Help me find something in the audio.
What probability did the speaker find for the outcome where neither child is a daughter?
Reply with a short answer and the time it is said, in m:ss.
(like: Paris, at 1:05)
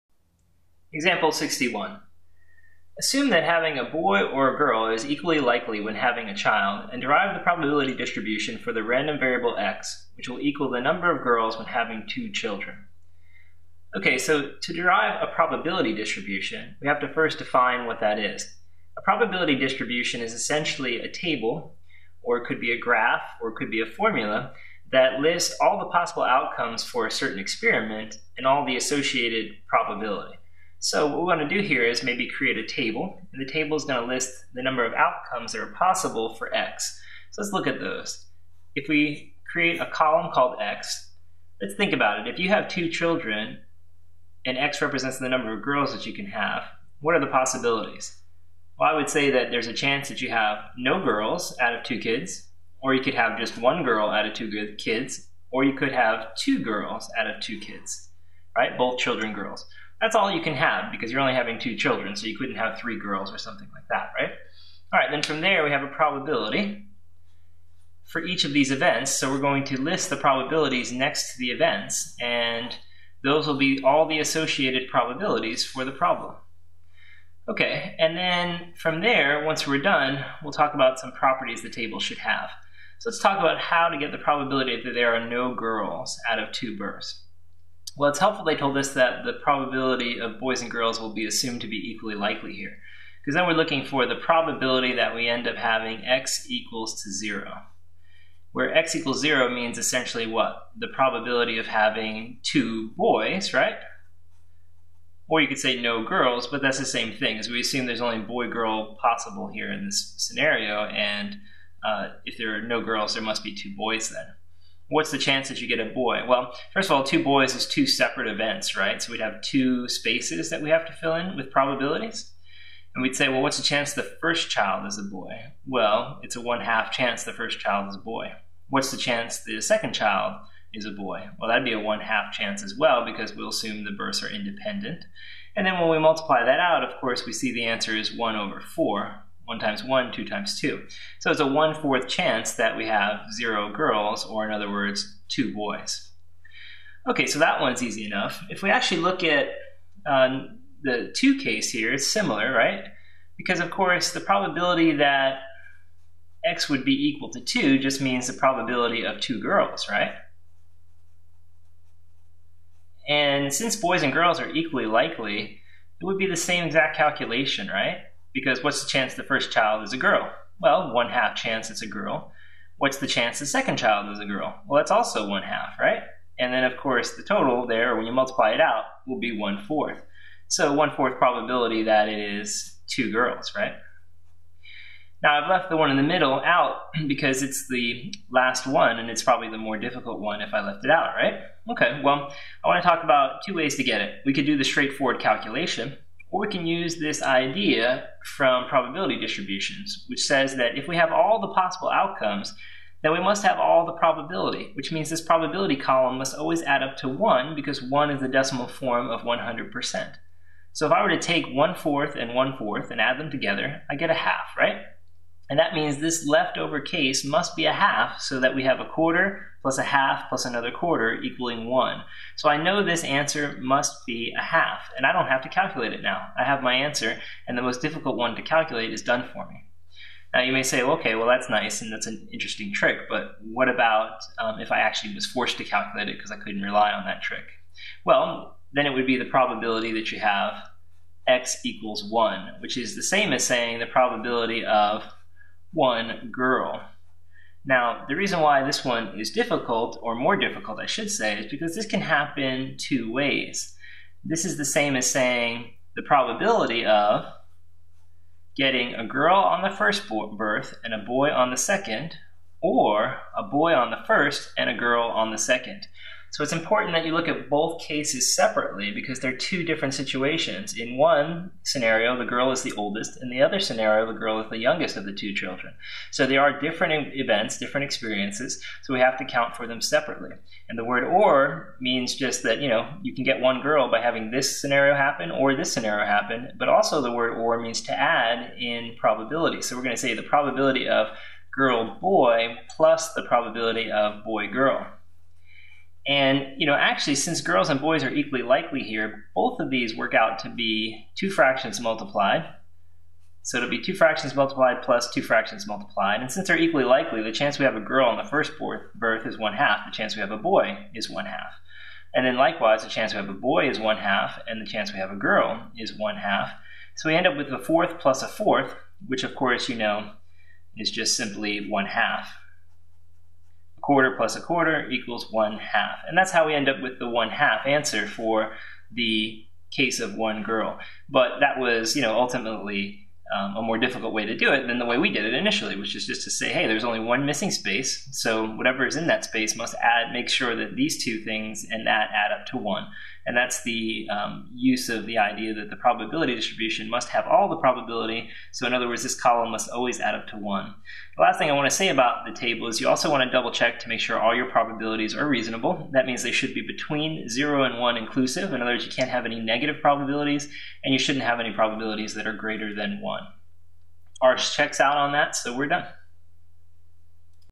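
1/4, at 2:18.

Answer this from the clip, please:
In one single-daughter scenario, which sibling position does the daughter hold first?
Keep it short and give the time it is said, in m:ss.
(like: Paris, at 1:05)
the oldest, at 4:32.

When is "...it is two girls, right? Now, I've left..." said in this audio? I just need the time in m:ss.
3:02.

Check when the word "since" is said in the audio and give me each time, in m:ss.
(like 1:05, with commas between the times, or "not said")
2:43, 4:57, 5:06.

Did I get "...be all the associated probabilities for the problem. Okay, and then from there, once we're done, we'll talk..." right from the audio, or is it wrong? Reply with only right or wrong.
right.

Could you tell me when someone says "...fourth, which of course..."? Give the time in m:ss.
5:18.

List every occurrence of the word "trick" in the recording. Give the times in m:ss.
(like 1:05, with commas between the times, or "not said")
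3:52, 3:57.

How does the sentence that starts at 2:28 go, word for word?
If we actually look at uh, the 2 case here, it's similar, right?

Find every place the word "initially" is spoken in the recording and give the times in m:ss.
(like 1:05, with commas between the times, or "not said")
5:35.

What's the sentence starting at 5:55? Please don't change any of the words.
That means they should be between zero and one inclusive.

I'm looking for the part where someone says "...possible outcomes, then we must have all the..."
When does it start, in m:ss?
3:21.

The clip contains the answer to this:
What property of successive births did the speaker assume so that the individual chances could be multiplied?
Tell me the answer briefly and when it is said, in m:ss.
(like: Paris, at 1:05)
independent, at 2:14.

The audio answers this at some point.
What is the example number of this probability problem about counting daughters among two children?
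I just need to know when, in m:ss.
0:01.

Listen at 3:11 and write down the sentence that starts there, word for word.
Okay, well, I want to talk about two ways to get it.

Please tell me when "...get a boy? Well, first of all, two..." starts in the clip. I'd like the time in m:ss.
1:55.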